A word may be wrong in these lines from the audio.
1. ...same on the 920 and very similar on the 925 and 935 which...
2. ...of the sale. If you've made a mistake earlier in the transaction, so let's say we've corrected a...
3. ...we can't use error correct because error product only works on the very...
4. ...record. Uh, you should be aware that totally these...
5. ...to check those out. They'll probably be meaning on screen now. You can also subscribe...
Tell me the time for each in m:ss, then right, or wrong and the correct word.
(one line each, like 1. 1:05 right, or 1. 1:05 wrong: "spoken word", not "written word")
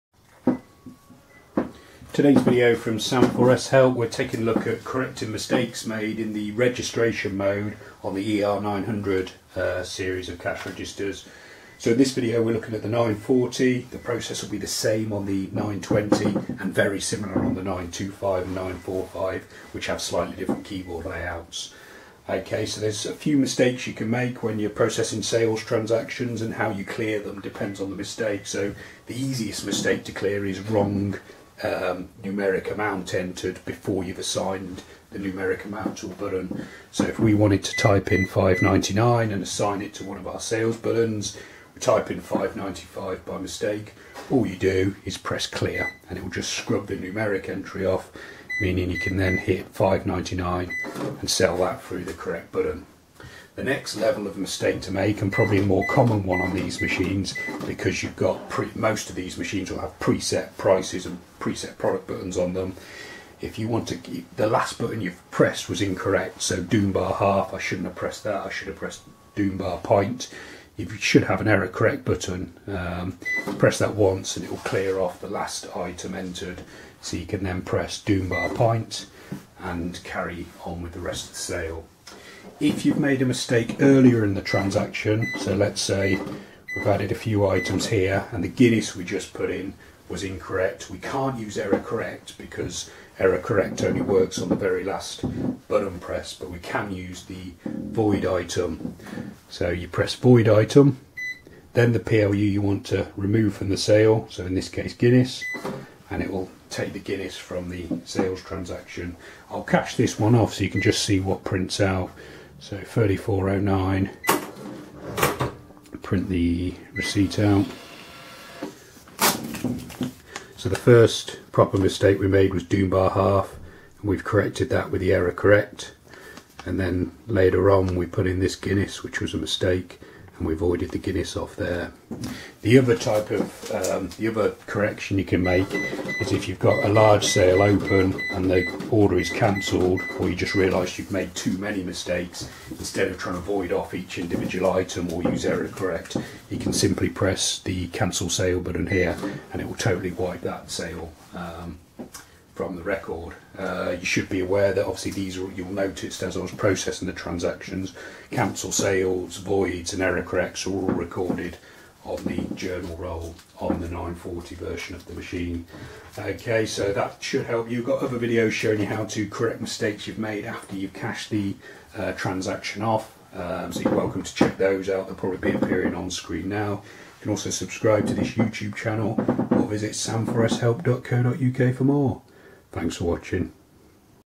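1. 0:14 wrong: "945", not "935"
2. 1:21 wrong: "added", not "corrected"
3. 1:30 wrong: "correct", not "product"
4. 2:32 wrong: "obviously", not "totally"
5. 2:54 wrong: "appearing", not "meaning".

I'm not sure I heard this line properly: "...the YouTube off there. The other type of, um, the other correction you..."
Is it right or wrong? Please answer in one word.
wrong.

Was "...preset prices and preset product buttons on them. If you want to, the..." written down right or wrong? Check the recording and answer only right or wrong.
right.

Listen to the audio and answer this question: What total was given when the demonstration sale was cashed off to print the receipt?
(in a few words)
34.09.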